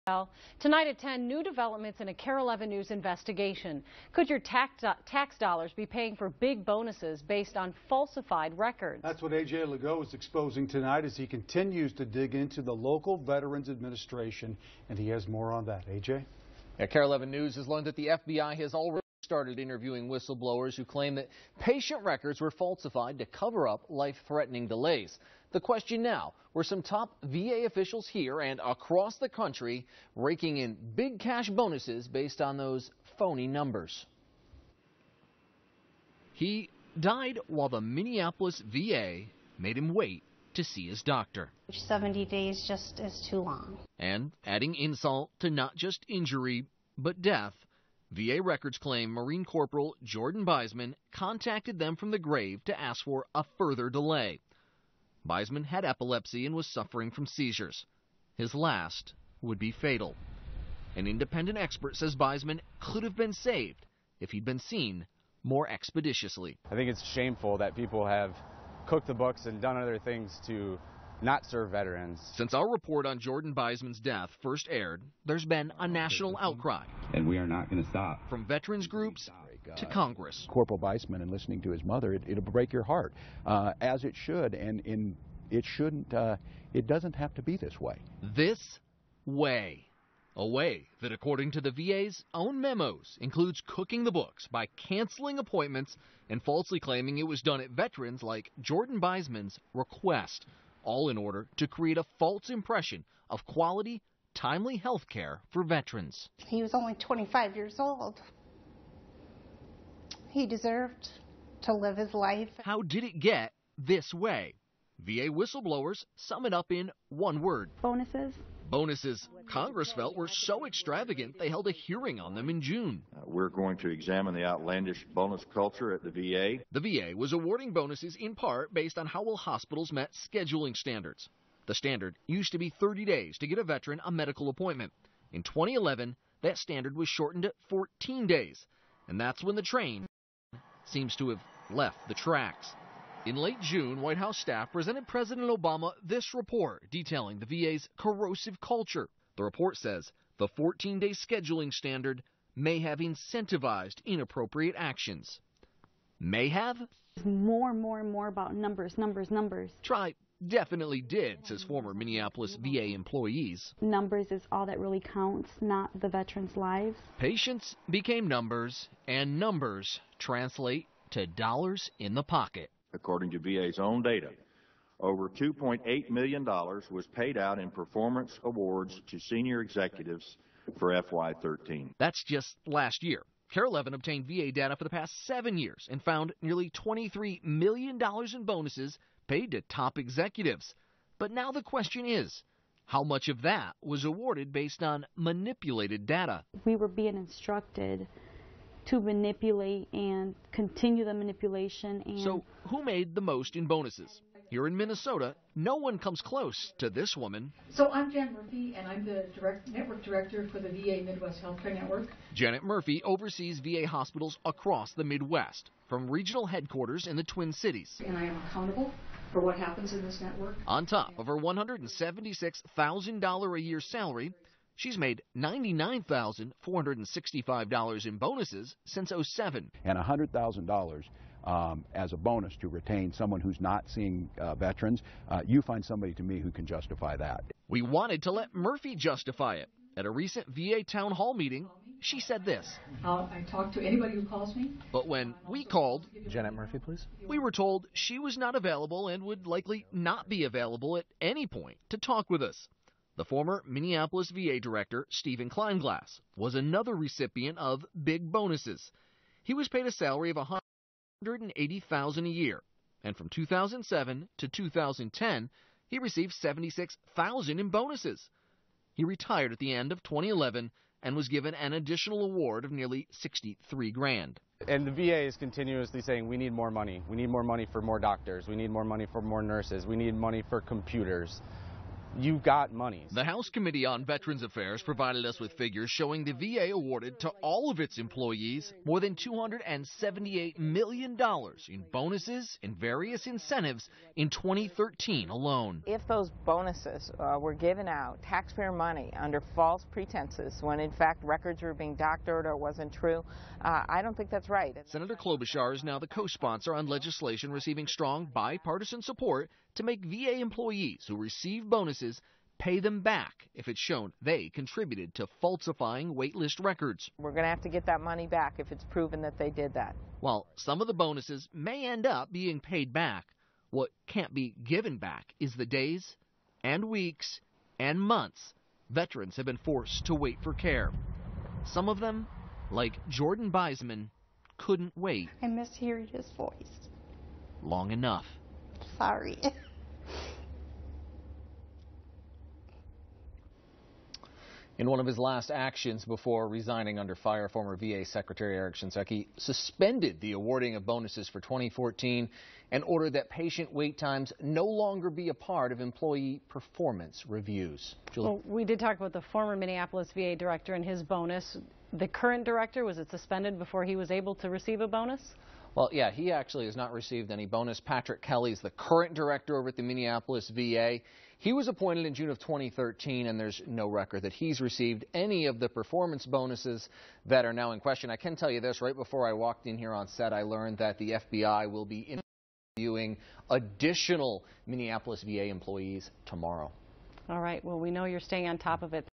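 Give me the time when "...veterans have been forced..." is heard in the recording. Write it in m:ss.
5:28.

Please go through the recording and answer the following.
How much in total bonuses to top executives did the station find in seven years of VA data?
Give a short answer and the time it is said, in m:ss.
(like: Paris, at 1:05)
$23 million, at 3:06.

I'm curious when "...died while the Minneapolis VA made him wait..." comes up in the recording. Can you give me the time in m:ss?
0:36.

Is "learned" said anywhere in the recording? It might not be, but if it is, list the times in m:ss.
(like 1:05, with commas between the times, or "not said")
0:17, 6:20.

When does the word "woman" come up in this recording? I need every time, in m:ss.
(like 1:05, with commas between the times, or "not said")
3:27.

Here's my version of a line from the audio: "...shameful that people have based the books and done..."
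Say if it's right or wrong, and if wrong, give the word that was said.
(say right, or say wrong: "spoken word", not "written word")
wrong: "cooked", not "based".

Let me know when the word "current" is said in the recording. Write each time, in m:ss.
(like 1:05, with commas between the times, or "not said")
6:02, 6:08.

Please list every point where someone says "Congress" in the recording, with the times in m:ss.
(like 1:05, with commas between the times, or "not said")
1:19, 1:59.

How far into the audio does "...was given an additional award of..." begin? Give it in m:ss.
4:31.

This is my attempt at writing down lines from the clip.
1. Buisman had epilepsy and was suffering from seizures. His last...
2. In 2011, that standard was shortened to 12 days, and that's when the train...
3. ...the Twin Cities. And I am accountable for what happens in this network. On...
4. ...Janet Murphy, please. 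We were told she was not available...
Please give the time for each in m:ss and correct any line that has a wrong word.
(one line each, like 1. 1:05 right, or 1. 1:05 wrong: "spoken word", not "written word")
1. 0:55 right
2. 2:15 wrong: "14", not "12"
3. 3:37 right
4. 4:06 right.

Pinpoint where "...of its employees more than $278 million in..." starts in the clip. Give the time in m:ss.
4:47.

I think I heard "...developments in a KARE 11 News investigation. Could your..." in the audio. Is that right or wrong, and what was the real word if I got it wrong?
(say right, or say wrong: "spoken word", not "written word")
right.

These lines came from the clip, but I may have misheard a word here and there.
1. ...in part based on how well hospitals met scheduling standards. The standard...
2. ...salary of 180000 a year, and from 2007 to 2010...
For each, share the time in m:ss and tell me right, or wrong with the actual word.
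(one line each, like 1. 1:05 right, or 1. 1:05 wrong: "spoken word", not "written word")
1. 2:08 right
2. 4:19 right.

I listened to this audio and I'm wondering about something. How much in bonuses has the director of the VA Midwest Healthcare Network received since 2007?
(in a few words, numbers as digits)
$99,465.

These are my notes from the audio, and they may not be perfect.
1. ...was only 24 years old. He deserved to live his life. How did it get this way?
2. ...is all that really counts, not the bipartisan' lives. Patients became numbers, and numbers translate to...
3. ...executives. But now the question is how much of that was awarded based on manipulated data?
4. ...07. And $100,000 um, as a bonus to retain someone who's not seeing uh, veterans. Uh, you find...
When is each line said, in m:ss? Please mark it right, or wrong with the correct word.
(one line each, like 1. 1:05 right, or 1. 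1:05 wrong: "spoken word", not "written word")
1. 1:46 wrong: "25", not "24"
2. 2:44 wrong: "veterans", not "bipartisan"
3. 3:09 right
4. 3:49 right.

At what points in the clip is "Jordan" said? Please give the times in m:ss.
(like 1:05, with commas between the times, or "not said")
0:50, 1:13, 1:38, 5:33.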